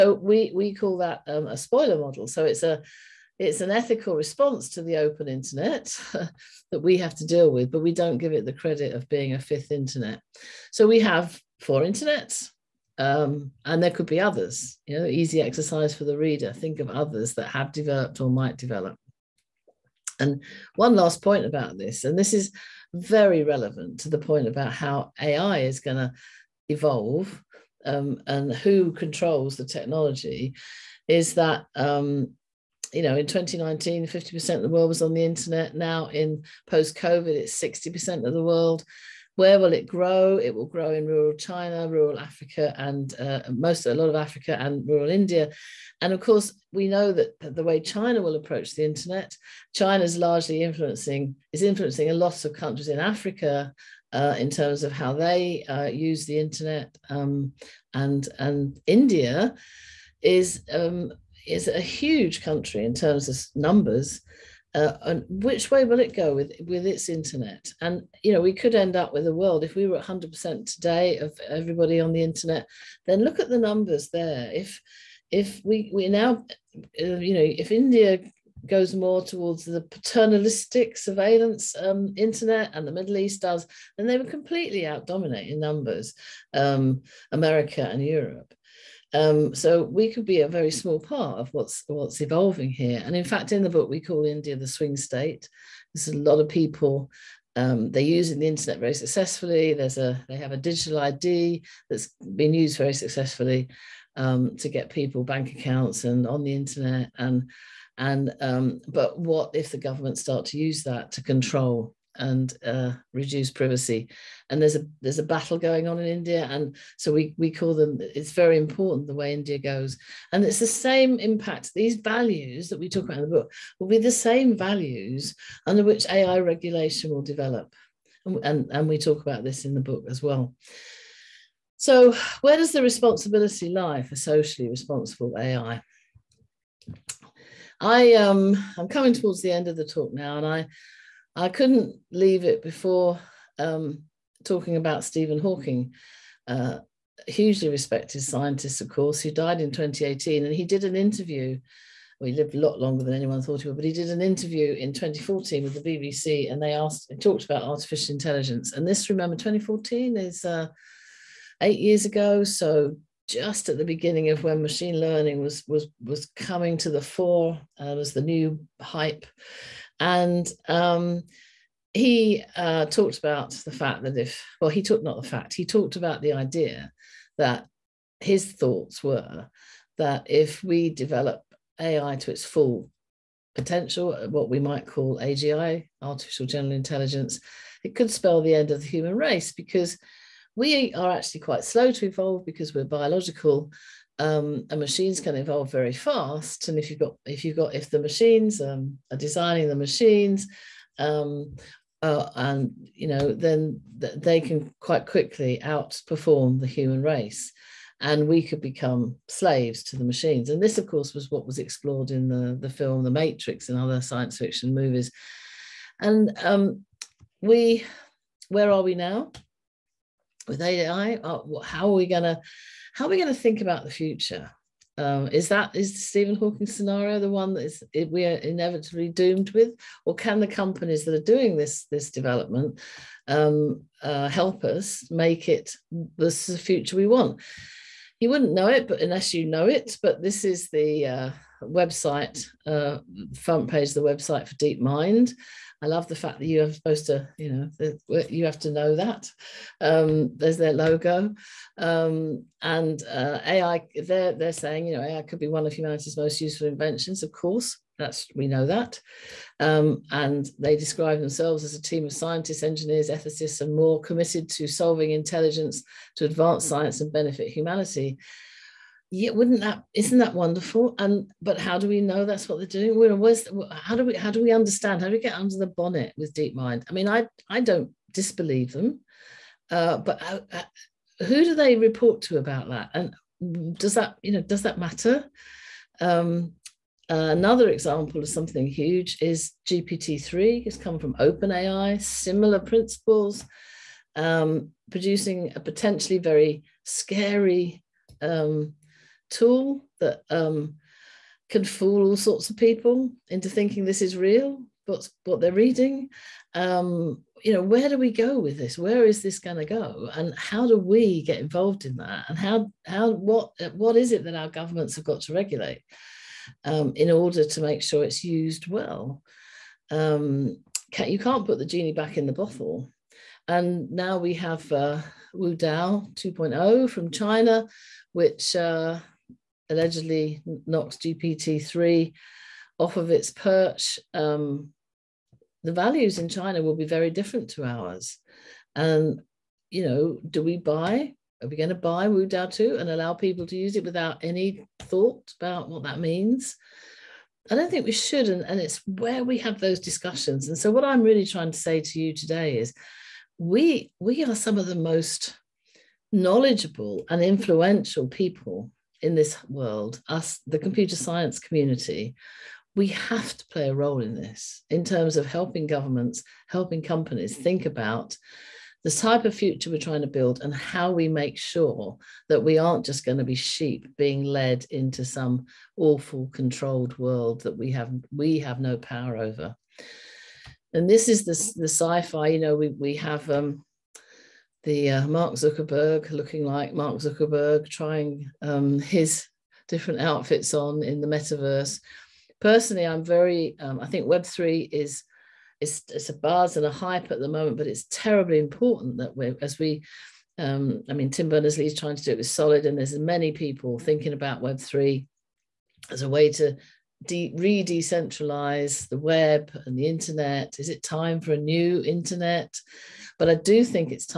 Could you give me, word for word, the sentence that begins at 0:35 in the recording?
Now in post-COVID, it's 60% of the world.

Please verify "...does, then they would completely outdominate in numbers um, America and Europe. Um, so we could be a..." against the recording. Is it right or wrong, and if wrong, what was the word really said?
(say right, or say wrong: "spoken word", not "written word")
right.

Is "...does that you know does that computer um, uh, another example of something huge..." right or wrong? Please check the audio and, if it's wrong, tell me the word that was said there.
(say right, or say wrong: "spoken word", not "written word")
wrong: "matter", not "computer".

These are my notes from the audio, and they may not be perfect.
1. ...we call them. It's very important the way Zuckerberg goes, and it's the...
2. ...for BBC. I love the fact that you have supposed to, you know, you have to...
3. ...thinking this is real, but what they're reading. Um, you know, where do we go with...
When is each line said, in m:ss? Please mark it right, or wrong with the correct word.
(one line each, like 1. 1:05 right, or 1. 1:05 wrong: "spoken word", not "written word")
1. 1:57 wrong: "India", not "Zuckerberg"
2. 4:04 wrong: "DeepMind", not "BBC"
3. 5:03 right.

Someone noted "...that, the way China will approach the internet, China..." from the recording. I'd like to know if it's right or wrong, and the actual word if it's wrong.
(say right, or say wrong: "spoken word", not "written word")
right.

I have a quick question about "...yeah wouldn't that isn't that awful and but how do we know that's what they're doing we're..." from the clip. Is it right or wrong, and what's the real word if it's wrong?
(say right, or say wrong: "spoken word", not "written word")
wrong: "wonderful", not "awful".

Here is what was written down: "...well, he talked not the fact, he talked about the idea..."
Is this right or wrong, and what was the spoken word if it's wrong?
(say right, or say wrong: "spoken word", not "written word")
right.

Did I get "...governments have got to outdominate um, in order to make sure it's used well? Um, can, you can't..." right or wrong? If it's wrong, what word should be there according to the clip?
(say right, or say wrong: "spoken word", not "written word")
wrong: "regulate", not "outdominate".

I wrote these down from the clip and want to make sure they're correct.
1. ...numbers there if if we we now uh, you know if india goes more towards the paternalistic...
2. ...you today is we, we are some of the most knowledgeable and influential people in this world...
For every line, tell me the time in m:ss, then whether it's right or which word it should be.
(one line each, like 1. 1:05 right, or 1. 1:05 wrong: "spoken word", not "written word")
1. 1:13 right
2. 5:52 right.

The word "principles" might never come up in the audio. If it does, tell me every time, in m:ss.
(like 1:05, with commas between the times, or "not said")
4:52.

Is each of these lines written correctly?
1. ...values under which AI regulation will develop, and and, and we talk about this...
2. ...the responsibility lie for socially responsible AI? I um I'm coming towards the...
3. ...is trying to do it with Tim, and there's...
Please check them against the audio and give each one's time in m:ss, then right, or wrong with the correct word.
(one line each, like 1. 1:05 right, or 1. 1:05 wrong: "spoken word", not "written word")
1. 2:04 right
2. 2:12 right
3. 6:41 wrong: "Solid", not "Tim".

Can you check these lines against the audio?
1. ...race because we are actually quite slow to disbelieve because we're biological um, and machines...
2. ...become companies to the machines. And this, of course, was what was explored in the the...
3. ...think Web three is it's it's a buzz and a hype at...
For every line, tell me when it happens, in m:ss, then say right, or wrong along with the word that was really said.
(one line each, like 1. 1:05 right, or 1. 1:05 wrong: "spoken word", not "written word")
1. 3:09 wrong: "evolve", not "disbelieve"
2. 3:28 wrong: "slaves", not "companies"
3. 6:33 right.